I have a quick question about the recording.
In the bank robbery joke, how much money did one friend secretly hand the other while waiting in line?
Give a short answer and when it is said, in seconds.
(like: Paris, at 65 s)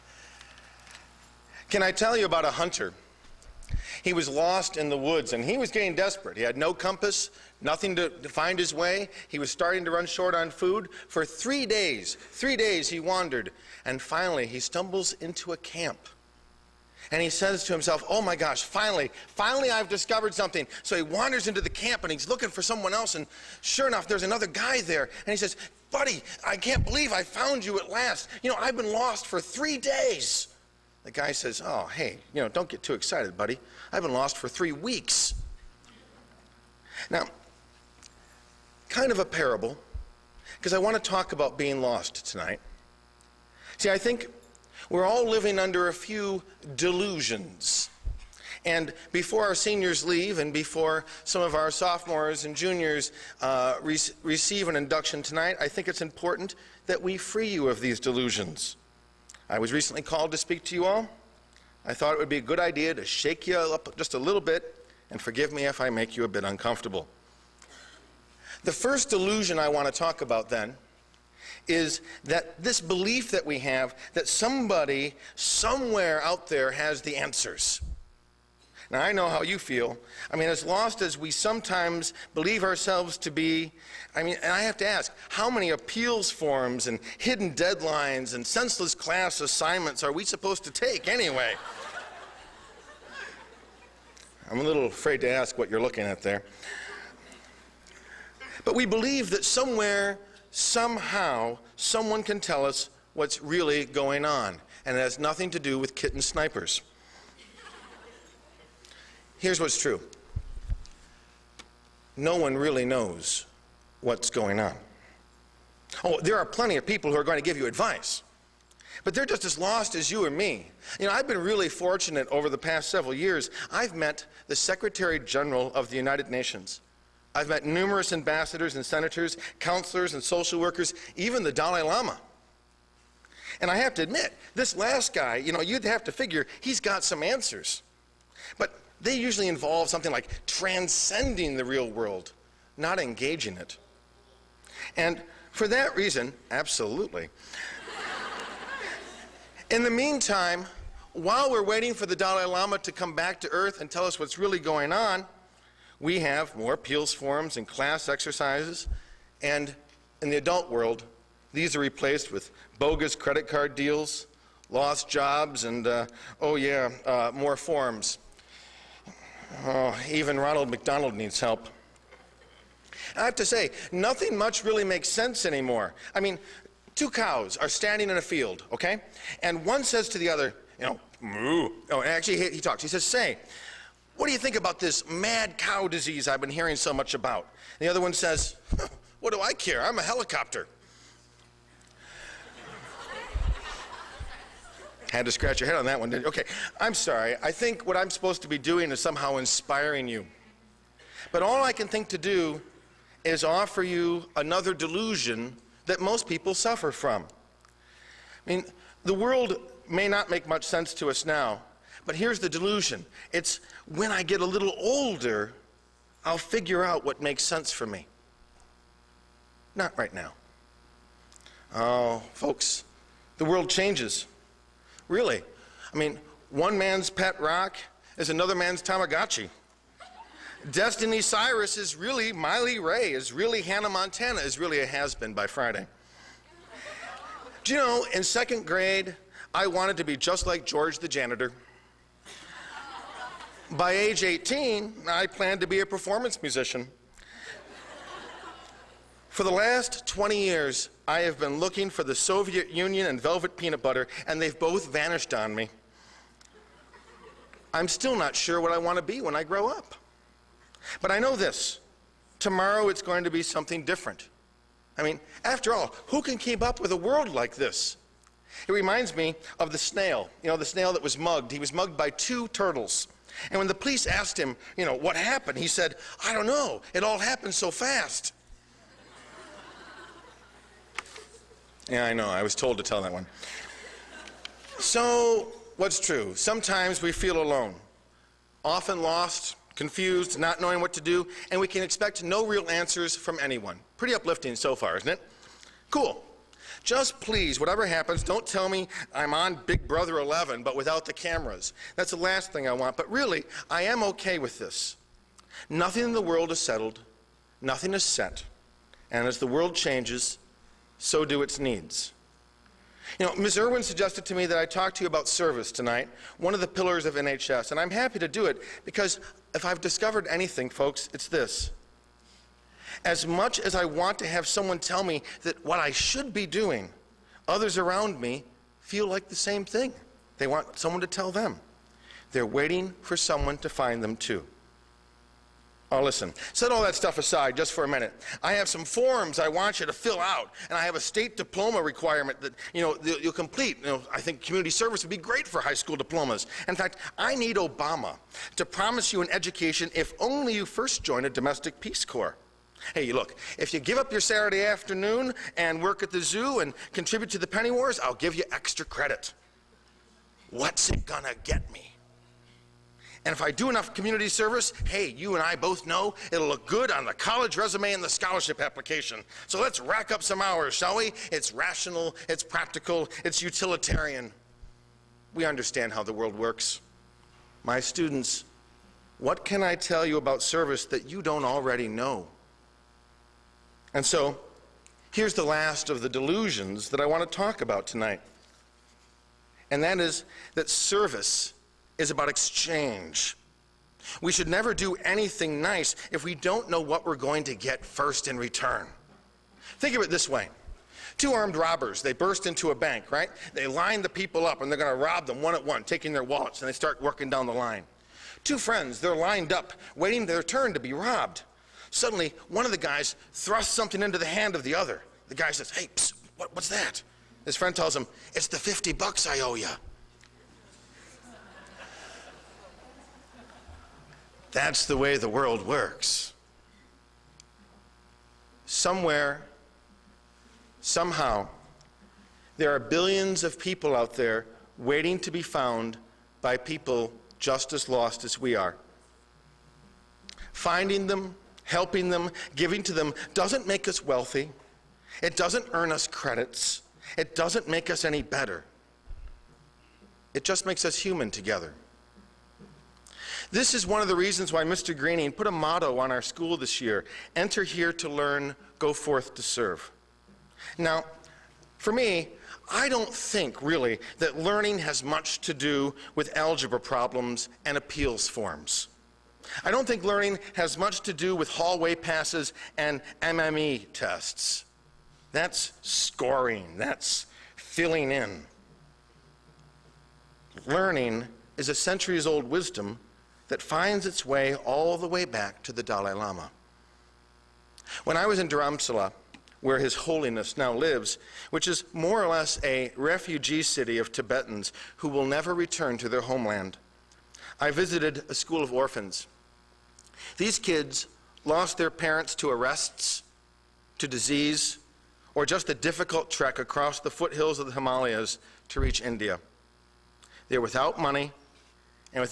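$50, at 418 s.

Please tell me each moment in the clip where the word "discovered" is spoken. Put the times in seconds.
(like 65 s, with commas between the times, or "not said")
19 s, 319 s.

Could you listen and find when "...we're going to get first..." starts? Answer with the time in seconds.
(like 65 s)
397 s.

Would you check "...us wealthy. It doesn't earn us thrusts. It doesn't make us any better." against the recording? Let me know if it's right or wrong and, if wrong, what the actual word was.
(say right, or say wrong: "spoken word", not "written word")
wrong: "credits", not "thrusts".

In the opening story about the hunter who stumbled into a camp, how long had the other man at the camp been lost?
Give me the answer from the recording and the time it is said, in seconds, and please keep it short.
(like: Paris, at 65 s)
3 weeks, at 34 s.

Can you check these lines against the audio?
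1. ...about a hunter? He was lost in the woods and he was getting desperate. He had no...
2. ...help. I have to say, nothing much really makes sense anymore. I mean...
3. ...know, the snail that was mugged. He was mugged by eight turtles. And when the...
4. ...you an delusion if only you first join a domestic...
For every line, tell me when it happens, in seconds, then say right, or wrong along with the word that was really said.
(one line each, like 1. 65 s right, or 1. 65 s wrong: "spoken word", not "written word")
1. 2 s right
2. 171 s right
3. 270 s wrong: "two", not "eight"
4. 349 s wrong: "education", not "delusion".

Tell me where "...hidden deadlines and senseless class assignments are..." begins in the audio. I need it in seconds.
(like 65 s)
87 s.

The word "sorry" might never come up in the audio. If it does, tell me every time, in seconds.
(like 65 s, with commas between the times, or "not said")
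196 s.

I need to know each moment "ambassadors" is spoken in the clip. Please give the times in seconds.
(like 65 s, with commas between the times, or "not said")
128 s.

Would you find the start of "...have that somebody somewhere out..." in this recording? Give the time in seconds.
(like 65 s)
73 s.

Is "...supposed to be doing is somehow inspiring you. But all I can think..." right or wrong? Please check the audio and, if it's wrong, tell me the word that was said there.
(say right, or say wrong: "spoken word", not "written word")
right.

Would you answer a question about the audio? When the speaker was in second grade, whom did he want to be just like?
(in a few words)
George the janitor.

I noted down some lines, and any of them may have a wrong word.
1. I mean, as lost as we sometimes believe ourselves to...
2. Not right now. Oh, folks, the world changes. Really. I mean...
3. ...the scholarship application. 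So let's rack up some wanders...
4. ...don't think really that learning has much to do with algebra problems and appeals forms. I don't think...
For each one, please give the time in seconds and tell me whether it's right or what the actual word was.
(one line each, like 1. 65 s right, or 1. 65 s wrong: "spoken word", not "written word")
1. 80 s right
2. 219 s right
3. 368 s wrong: "hours", not "wanders"
4. 462 s right.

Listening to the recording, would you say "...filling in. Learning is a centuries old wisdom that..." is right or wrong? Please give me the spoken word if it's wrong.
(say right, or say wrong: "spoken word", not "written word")
right.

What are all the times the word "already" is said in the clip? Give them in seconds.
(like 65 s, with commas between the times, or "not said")
381 s.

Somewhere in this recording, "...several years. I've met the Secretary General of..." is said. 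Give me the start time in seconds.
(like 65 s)
122 s.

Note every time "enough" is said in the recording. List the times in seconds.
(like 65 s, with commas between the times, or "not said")
23 s, 363 s.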